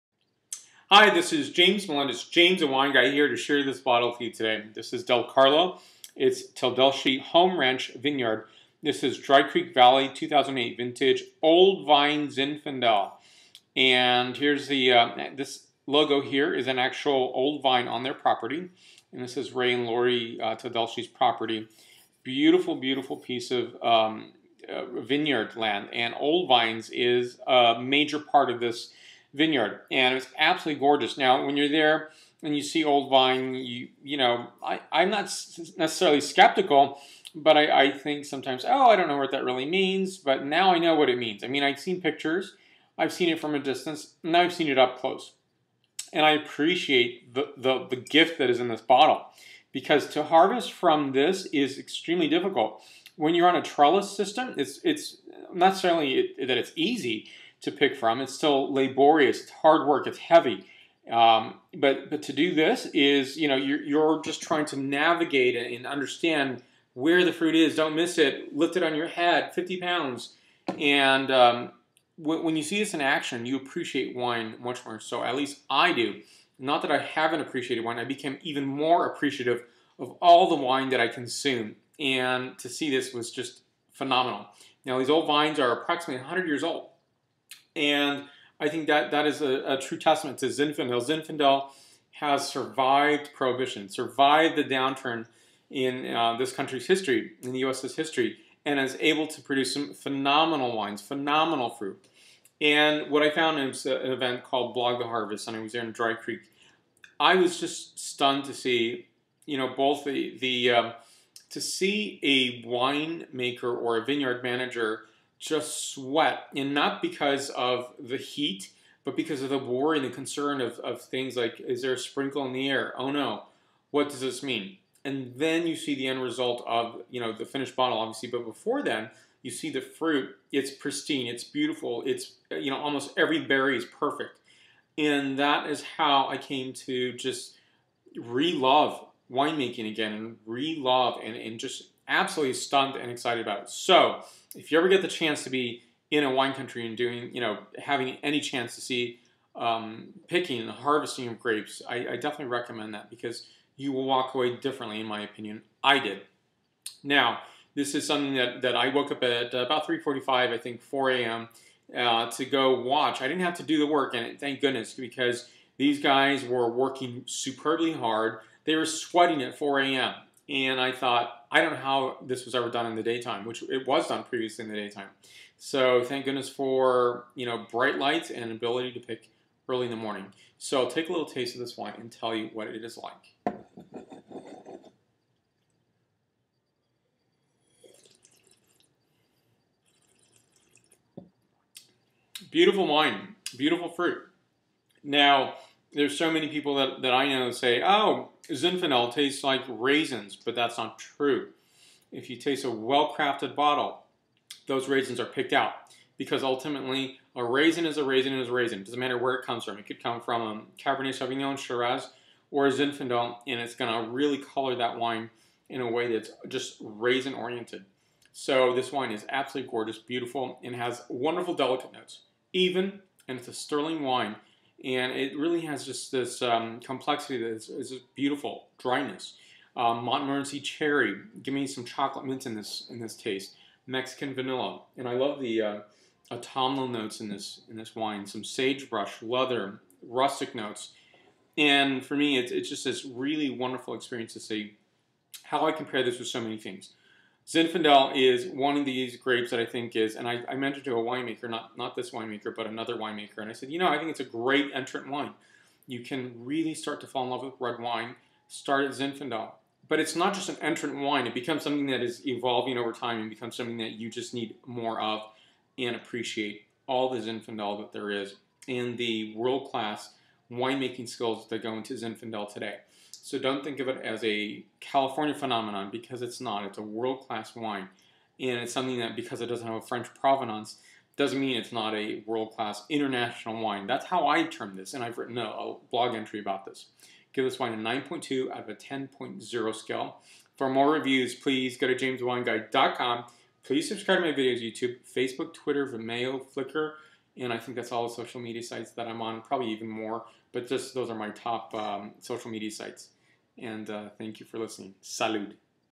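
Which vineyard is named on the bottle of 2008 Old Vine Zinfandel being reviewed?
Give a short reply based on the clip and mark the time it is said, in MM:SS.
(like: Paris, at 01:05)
Teldeschi Home Ranch Vineyard, at 00:06.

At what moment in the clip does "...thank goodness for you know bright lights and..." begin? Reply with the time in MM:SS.
02:56.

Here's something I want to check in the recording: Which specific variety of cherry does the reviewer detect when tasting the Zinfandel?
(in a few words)
Montmorency.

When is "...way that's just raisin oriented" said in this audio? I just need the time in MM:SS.
03:35.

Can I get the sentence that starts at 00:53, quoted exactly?
When you're on a trellis system, it's, it's not necessarily that it's easy, to pick from.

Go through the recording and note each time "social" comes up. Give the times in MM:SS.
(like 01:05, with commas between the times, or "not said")
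04:58, 05:02.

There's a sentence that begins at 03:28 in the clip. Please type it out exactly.
It doesn't matter where it comes from.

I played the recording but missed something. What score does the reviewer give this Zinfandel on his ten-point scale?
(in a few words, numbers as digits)
9.2.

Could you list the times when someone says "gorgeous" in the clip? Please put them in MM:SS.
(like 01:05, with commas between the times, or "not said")
00:30, 03:39.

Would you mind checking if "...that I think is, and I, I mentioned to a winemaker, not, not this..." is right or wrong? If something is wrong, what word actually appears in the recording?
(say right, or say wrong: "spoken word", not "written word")
right.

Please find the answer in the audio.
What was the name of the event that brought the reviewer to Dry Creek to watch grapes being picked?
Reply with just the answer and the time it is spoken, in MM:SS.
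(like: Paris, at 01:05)
Blog the Harvest, at 01:44.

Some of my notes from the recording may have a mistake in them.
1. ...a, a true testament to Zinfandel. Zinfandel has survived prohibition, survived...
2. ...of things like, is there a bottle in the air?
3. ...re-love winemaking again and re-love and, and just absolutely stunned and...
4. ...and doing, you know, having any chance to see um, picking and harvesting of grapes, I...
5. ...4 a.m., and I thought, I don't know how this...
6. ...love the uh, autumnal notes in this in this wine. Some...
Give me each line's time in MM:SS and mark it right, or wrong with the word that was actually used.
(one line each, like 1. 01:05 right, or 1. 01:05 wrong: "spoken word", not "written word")
1. 01:29 right
2. 02:00 wrong: "sprinkle", not "bottle"
3. 02:18 right
4. 02:26 right
5. 02:49 right
6. 03:55 right.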